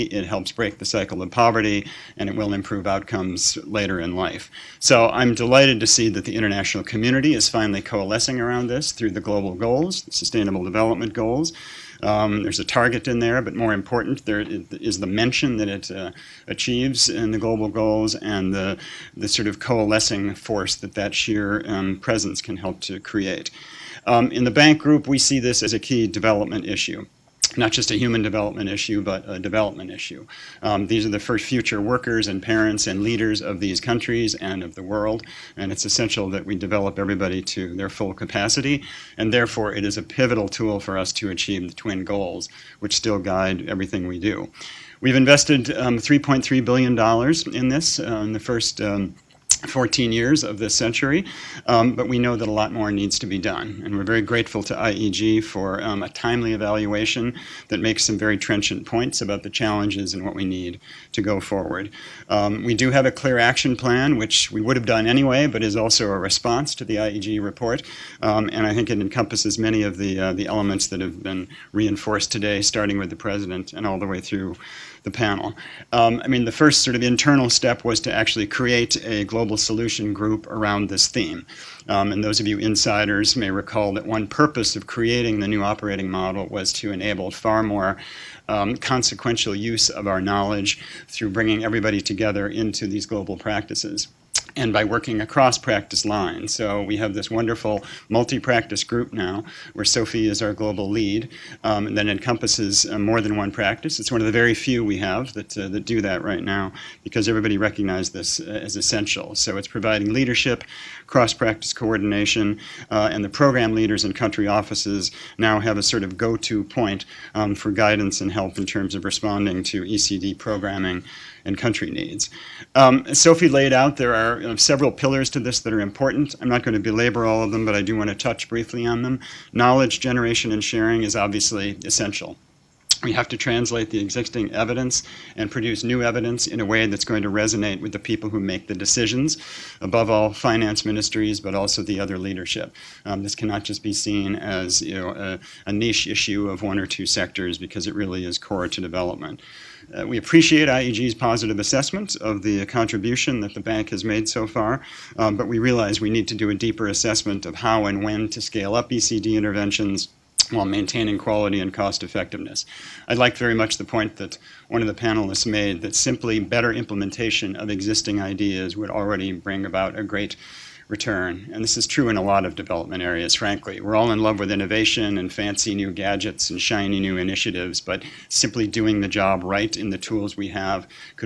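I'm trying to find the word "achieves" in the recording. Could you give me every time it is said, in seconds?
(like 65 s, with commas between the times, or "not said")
16 s, 41 s.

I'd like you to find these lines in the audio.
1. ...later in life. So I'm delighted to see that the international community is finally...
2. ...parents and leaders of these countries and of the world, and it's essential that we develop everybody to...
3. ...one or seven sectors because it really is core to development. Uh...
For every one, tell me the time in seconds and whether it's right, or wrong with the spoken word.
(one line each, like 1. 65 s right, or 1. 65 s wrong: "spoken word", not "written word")
1. 3 s right
2. 32 s right
3. 146 s wrong: "two", not "seven".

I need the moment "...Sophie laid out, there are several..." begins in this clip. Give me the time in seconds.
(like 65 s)
123 s.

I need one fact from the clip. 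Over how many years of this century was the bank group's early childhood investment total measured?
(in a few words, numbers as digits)
14.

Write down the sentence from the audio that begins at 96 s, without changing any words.
So we have this wonderful multi-practice group now, where Sophie is our global lead, um, that encompasses uh, more than one practice.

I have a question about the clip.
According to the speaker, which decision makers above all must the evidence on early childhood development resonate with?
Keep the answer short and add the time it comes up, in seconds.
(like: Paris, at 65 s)
Finance ministries, at 140 s.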